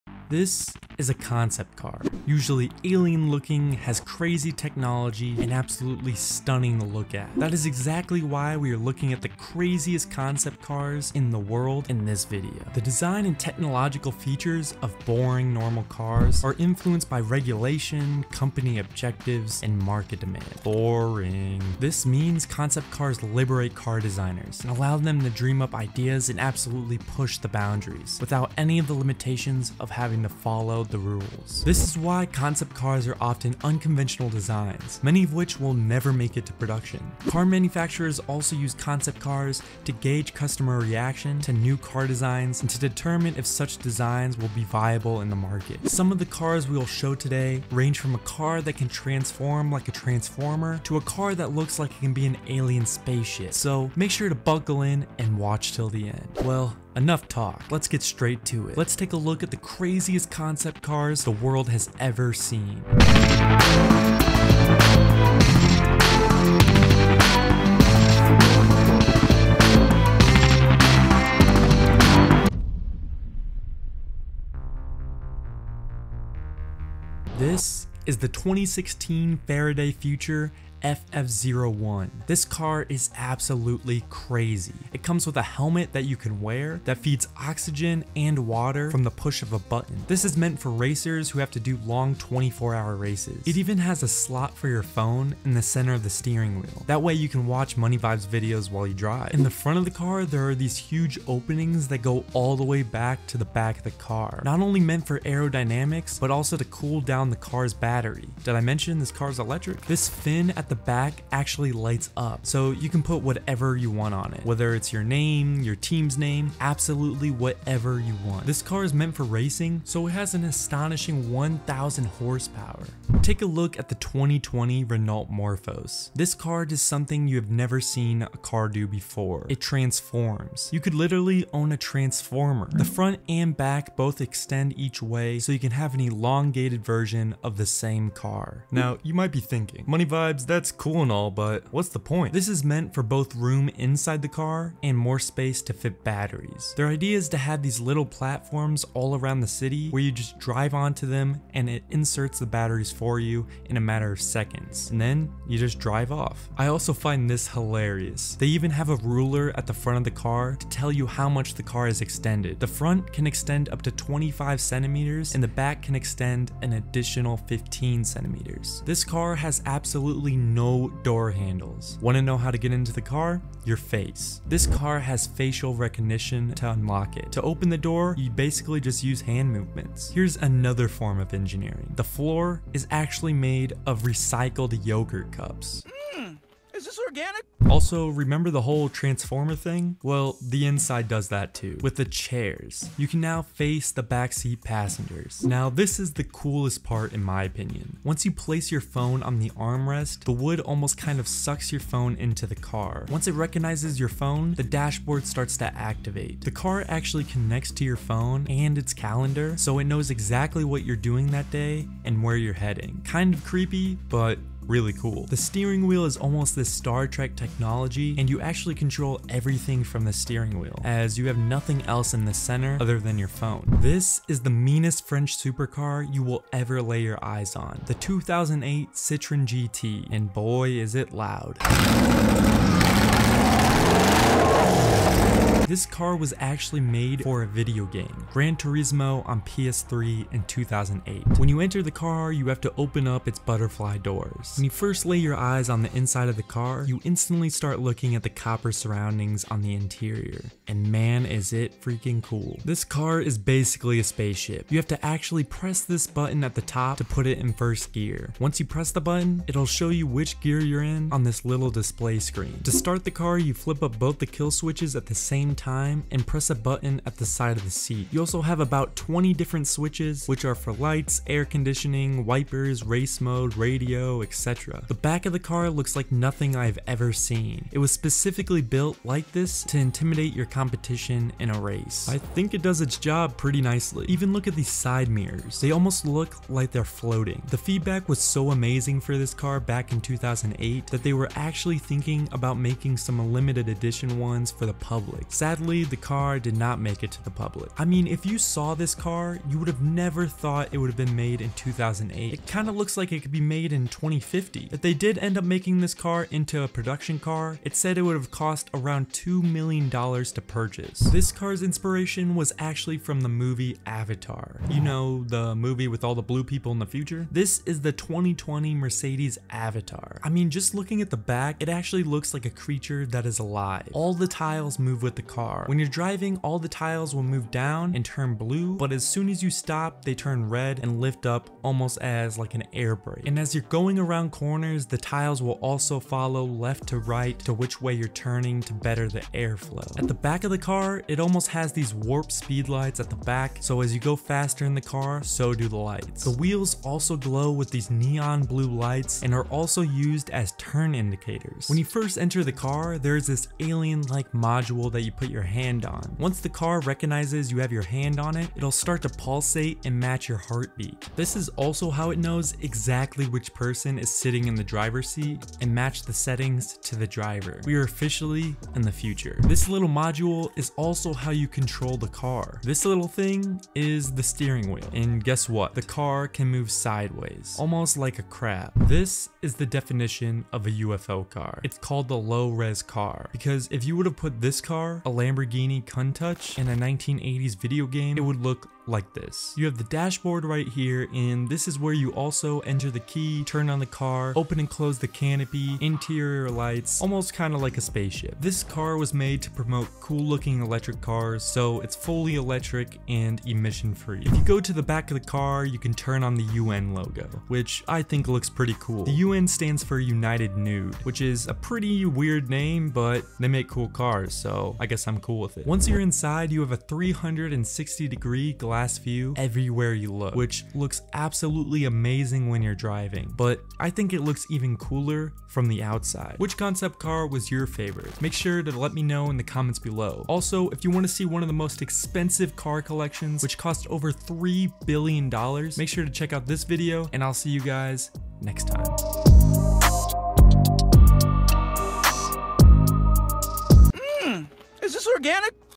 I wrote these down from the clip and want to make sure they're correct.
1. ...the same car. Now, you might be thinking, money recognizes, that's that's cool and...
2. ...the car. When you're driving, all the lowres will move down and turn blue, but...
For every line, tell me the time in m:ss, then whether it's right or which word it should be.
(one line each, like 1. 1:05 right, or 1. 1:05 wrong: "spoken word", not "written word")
1. 2:17 wrong: "vibes", not "recognizes"
2. 5:25 wrong: "tiles", not "lowres".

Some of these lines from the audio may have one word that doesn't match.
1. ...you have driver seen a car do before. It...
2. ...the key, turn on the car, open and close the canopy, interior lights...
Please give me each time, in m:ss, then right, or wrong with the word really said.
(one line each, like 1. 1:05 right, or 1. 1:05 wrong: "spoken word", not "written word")
1. 2:07 wrong: "never", not "driver"
2. 6:32 right.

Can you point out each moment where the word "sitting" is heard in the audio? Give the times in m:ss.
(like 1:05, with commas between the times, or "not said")
6:04.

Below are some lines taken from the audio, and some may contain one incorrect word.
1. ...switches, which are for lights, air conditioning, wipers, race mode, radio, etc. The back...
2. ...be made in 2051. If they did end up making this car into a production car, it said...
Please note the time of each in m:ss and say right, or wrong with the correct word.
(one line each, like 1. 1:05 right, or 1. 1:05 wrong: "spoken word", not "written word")
1. 4:29 right
2. 5:03 wrong: "2050", not "2051".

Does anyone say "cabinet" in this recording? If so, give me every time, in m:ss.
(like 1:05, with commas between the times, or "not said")
not said.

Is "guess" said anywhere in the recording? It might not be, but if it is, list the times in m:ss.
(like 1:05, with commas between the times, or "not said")
6:15, 6:54.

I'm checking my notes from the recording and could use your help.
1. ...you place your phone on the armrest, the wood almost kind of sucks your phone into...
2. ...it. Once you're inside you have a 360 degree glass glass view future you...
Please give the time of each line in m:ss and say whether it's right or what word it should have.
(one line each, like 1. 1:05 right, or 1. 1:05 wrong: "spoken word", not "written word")
1. 3:18 right
2. 6:55 wrong: "everywhere", not "future".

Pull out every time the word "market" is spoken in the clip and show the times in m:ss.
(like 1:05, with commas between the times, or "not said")
0:19, 0:45.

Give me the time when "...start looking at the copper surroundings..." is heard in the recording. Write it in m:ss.
4:07.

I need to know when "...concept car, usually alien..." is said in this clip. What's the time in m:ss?
0:01.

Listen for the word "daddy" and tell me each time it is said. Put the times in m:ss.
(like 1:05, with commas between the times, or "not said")
not said.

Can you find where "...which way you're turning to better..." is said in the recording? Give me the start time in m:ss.
5:37.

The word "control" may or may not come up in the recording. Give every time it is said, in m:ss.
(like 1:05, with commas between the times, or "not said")
3:38, 6:11.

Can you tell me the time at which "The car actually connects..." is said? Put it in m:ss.
3:26.